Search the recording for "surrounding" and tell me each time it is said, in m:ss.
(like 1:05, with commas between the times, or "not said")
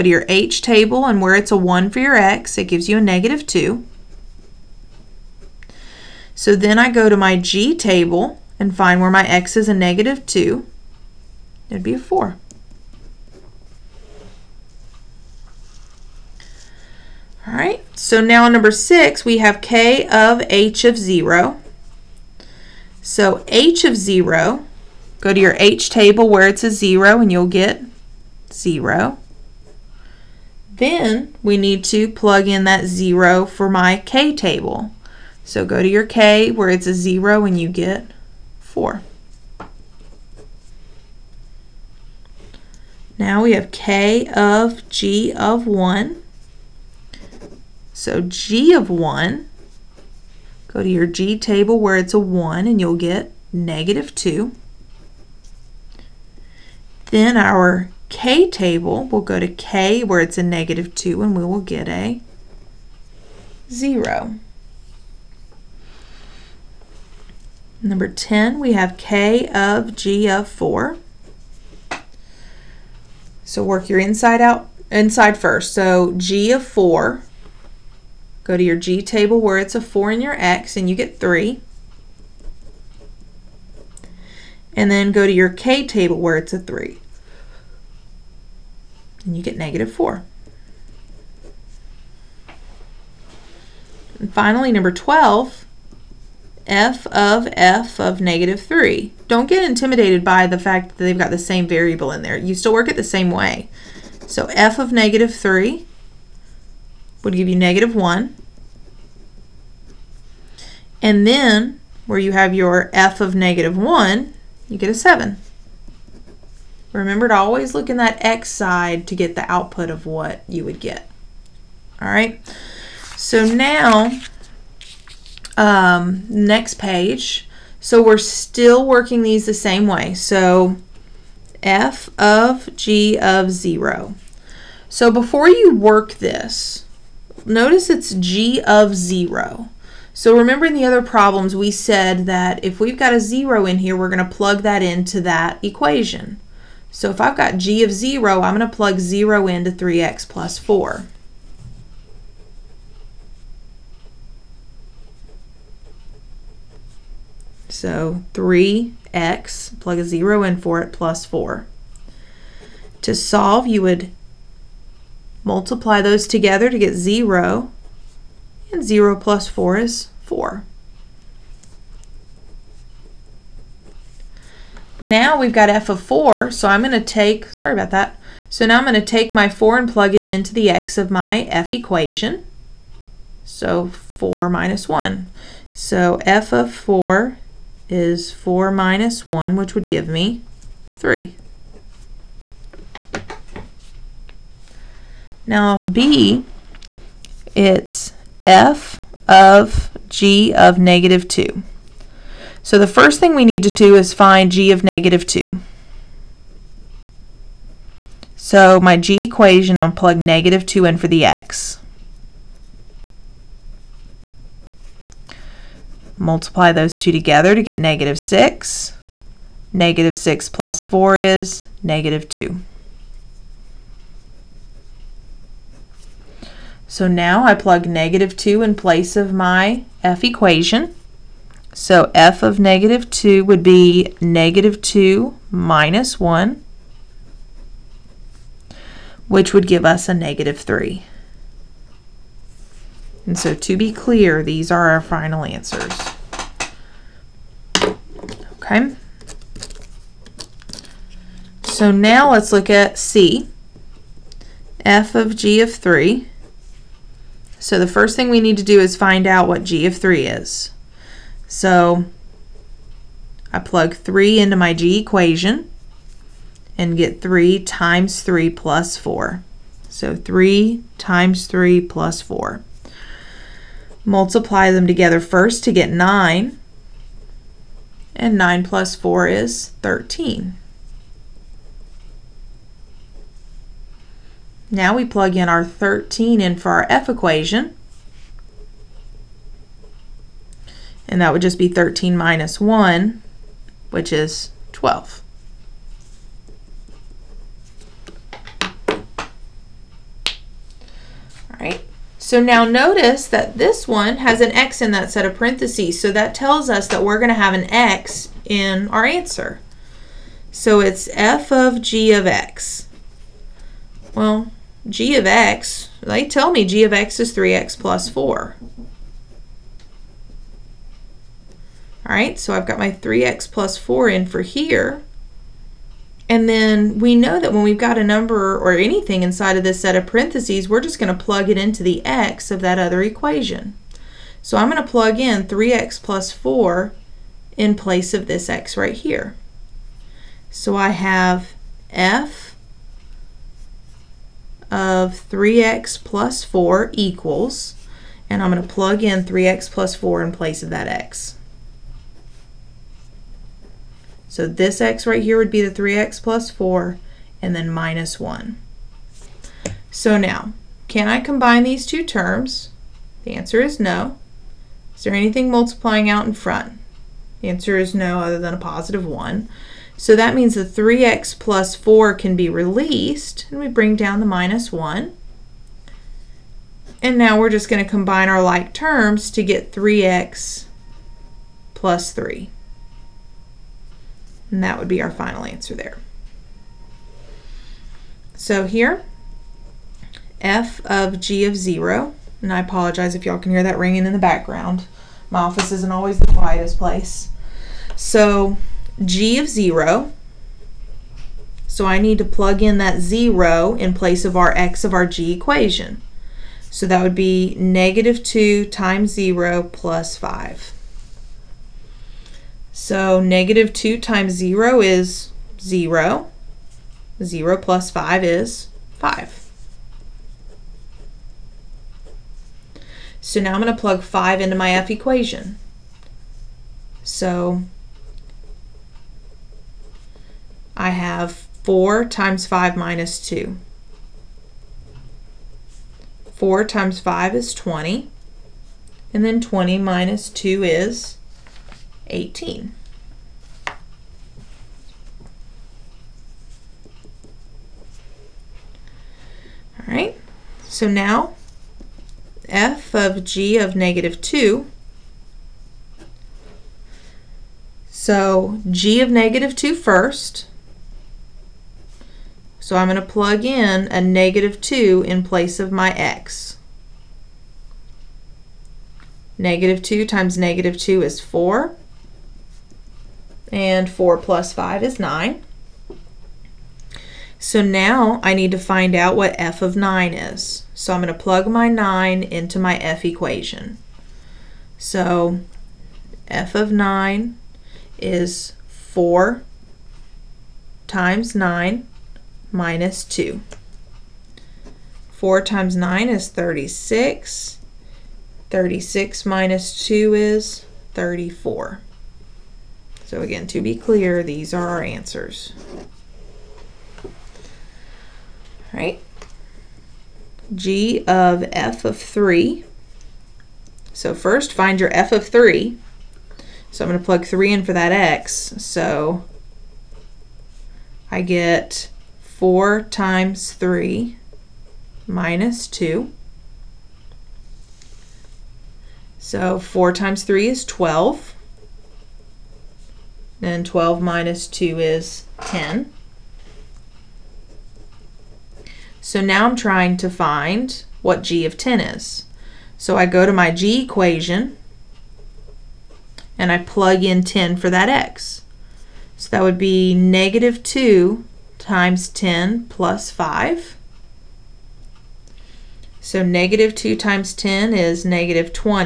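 not said.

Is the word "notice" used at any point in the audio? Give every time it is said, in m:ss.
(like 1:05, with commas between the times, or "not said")
2:17, 5:02.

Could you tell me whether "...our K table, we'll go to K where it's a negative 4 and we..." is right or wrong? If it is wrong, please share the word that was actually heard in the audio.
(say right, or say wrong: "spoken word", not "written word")
wrong: "2", not "4".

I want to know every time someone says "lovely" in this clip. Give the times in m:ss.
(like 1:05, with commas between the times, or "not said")
not said.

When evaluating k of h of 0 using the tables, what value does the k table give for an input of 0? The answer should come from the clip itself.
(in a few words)
4.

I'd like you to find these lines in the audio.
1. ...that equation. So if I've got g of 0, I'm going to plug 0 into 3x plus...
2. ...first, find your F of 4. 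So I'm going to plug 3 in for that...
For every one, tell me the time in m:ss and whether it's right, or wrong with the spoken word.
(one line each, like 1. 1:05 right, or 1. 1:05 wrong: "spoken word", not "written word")
1. 2:25 right
2. 8:34 wrong: "3", not "4".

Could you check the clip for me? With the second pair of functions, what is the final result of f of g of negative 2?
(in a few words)
34.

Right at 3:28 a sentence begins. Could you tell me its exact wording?
So my g equation, I'll plug negative 2 in for the x.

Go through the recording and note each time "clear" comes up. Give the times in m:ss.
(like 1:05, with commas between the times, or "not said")
4:03, 8:23.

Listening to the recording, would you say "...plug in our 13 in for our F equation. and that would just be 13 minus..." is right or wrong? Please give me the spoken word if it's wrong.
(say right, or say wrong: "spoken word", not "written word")
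right.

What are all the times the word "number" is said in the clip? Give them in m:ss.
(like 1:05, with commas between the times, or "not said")
0:18, 1:07, 1:34, 5:28.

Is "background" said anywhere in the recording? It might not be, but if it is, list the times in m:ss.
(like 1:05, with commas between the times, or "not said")
6:34.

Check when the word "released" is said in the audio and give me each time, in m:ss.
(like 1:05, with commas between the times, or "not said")
6:12.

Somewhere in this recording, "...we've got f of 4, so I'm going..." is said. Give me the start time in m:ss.
2:55.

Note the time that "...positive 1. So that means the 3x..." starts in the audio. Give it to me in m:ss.
6:08.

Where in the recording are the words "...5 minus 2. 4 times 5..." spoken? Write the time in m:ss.
7:12.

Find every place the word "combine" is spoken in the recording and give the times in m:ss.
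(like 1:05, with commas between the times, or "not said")
6:01, 6:17.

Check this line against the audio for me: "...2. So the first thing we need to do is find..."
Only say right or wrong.
right.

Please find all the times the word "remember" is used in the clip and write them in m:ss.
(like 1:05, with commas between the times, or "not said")
1:56, 2:20.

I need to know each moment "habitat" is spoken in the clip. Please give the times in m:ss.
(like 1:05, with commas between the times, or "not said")
not said.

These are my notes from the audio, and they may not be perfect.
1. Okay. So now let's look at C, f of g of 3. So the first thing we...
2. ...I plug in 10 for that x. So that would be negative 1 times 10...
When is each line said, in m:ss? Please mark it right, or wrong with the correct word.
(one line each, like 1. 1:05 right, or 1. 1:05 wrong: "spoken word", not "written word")
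1. 4:08 right
2. 9:06 wrong: "2", not "1".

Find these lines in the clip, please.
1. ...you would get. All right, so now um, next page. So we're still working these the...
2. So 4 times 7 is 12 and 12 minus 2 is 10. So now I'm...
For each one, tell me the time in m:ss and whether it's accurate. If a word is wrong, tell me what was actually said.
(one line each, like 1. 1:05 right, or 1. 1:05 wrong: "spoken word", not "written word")
1. 2:00 right
2. 8:49 wrong: "3", not "7".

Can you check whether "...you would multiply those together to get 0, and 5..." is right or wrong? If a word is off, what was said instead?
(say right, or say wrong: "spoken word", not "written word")
wrong: "0", not "5".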